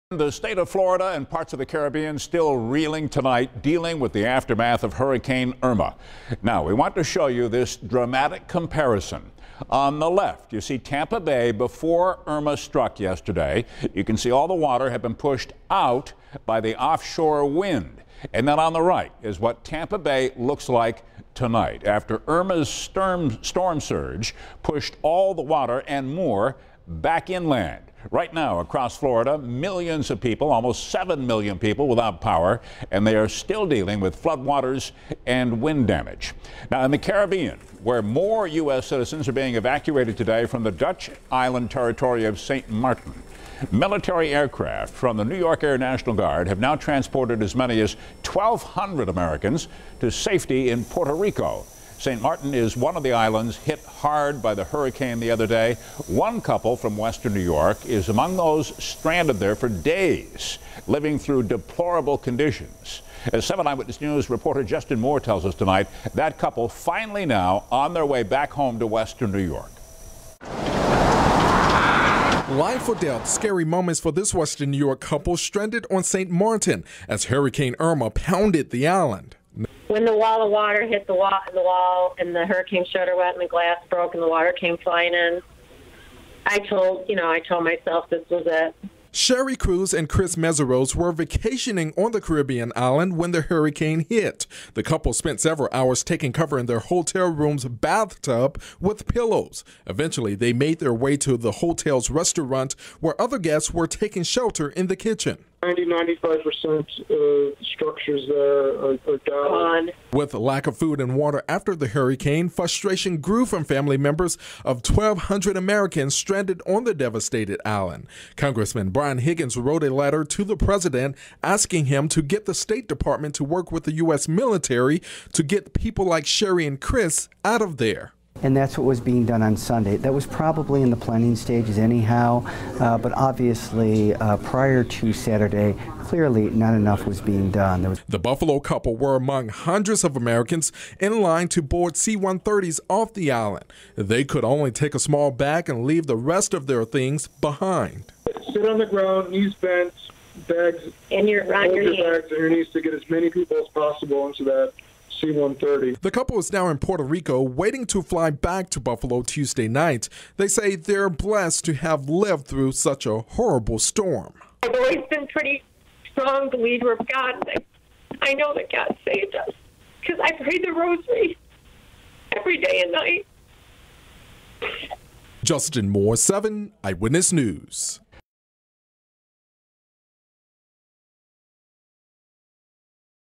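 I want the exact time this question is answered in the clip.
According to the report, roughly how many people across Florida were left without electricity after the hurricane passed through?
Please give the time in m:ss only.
0:30.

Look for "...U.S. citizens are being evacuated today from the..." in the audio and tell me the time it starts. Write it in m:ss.
0:38.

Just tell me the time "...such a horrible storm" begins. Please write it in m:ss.
2:42.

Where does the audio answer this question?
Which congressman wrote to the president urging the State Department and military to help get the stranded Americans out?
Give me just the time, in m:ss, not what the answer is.
1:58.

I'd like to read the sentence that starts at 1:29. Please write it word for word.
Sherry Cruz and Chris Meseros were vacationing on the Caribbean island when the hurricane hit.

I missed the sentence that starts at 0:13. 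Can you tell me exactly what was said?
You can see all the water had been pushed out by the offshore wind.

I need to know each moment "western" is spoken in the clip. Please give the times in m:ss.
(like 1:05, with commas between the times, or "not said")
0:56, 1:08, 1:14.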